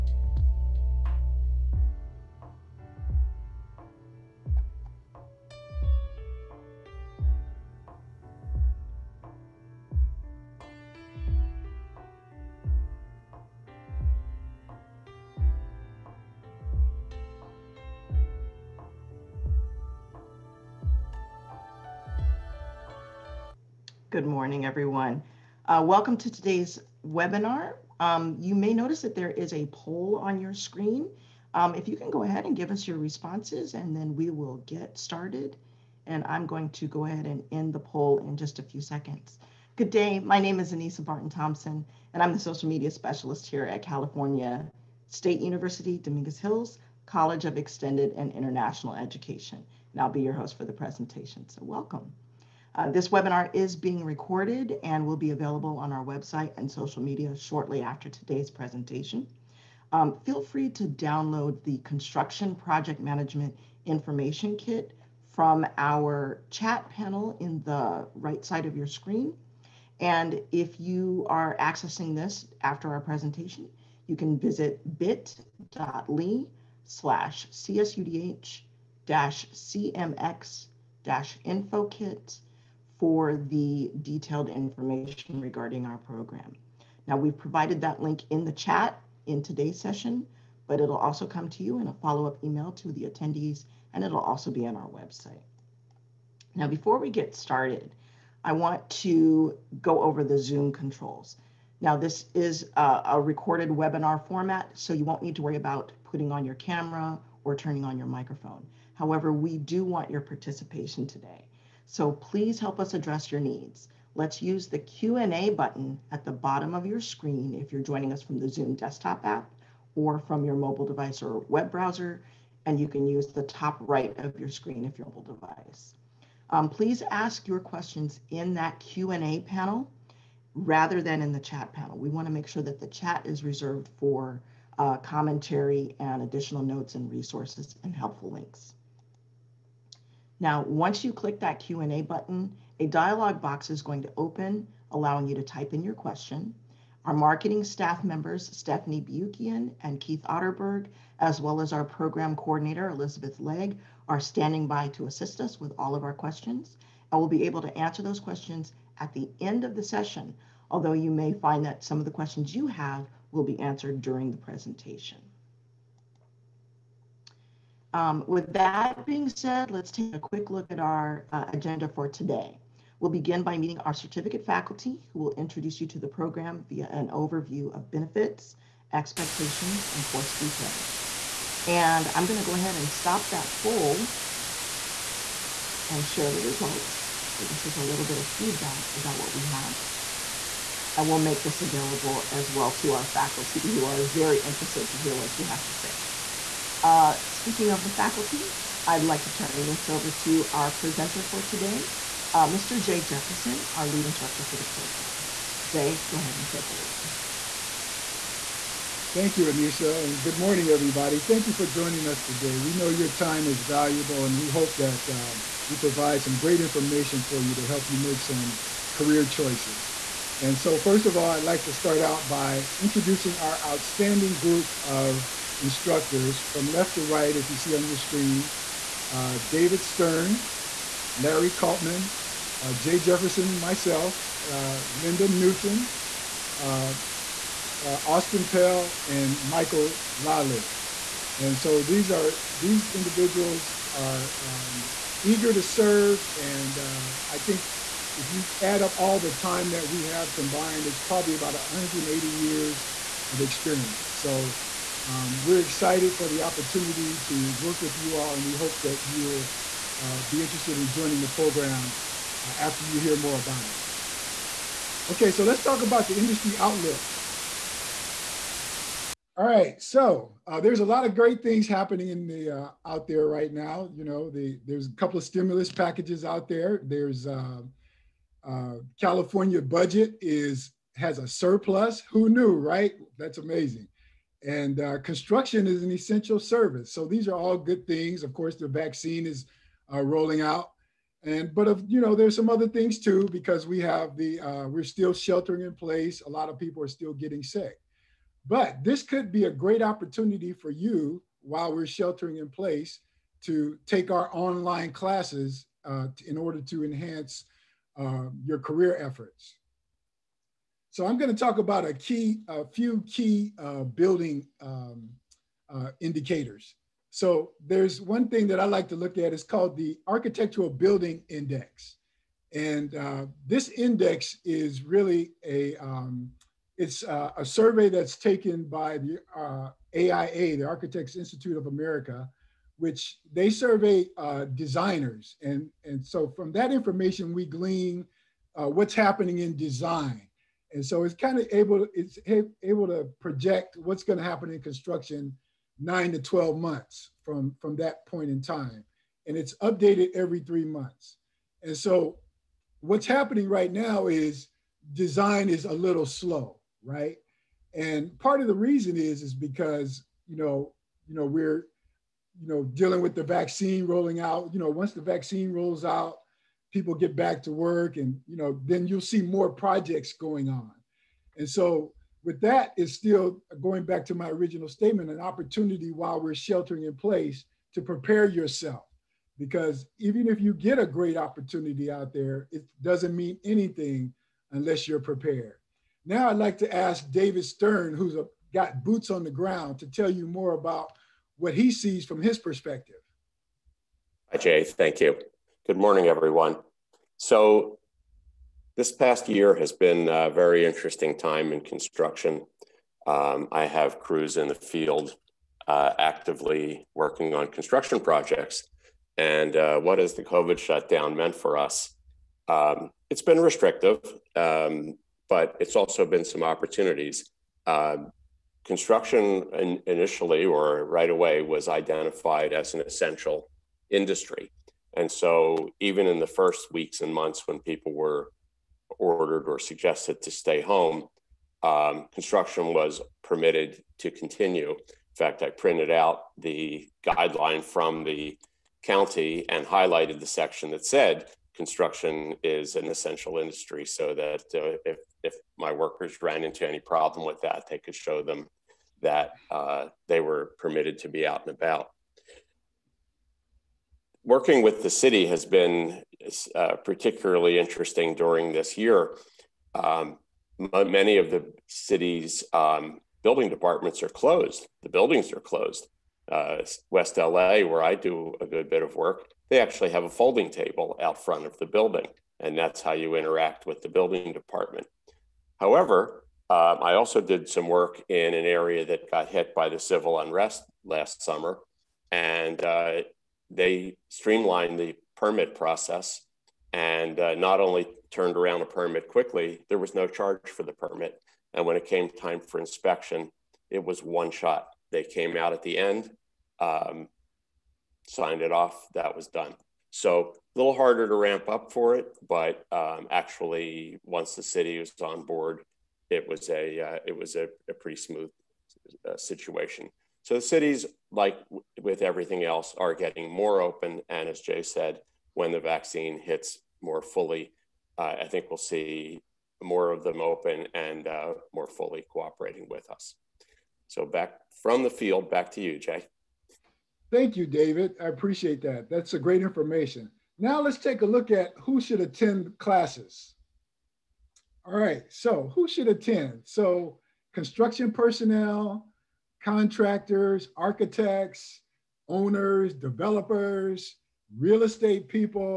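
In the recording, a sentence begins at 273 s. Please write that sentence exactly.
You know, the, there's a couple of stimulus packages out there.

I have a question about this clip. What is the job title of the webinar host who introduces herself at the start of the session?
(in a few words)
Social media specialist.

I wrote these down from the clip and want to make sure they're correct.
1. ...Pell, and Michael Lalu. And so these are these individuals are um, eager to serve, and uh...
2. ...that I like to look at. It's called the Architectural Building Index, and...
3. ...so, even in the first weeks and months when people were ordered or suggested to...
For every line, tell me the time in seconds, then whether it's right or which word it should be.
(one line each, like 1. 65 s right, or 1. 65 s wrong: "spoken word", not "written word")
1. 238 s right
2. 318 s right
3. 425 s right.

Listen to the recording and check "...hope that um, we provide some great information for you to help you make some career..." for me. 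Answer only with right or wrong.
right.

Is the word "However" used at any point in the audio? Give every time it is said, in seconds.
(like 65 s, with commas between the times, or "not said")
108 s, 475 s.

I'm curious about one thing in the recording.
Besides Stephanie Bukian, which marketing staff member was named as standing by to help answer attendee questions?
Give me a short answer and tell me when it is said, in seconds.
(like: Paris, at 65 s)
Keith Otterberg, at 150 s.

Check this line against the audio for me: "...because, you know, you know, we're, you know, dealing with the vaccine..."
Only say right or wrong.
right.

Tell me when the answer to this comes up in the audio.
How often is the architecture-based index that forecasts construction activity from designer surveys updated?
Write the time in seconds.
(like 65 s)
350 s.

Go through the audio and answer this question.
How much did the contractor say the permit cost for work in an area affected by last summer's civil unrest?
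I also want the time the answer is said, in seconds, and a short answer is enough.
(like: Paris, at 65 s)
No charge, at 489 s.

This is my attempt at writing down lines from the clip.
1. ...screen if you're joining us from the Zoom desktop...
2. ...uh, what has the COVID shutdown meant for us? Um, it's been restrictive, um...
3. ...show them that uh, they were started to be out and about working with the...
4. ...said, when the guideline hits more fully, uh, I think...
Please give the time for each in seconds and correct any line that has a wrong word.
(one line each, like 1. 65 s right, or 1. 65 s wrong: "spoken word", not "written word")
1. 116 s right
2. 409 s right
3. 447 s wrong: "permitted", not "started"
4. 514 s wrong: "vaccine", not "guideline".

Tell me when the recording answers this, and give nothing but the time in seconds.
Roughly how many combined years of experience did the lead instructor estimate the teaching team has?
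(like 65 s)
251 s.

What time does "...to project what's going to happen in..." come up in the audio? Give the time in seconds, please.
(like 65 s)
342 s.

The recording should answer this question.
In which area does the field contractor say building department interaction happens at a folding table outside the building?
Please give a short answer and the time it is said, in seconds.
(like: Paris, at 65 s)
West LA, at 466 s.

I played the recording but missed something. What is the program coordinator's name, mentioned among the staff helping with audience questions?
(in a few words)
Elizabeth Legg.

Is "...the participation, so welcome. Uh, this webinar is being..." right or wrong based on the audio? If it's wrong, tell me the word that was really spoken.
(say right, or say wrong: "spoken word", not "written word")
wrong: "presentation", not "participation".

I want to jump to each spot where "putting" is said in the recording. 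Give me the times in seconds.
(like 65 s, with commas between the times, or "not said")
106 s.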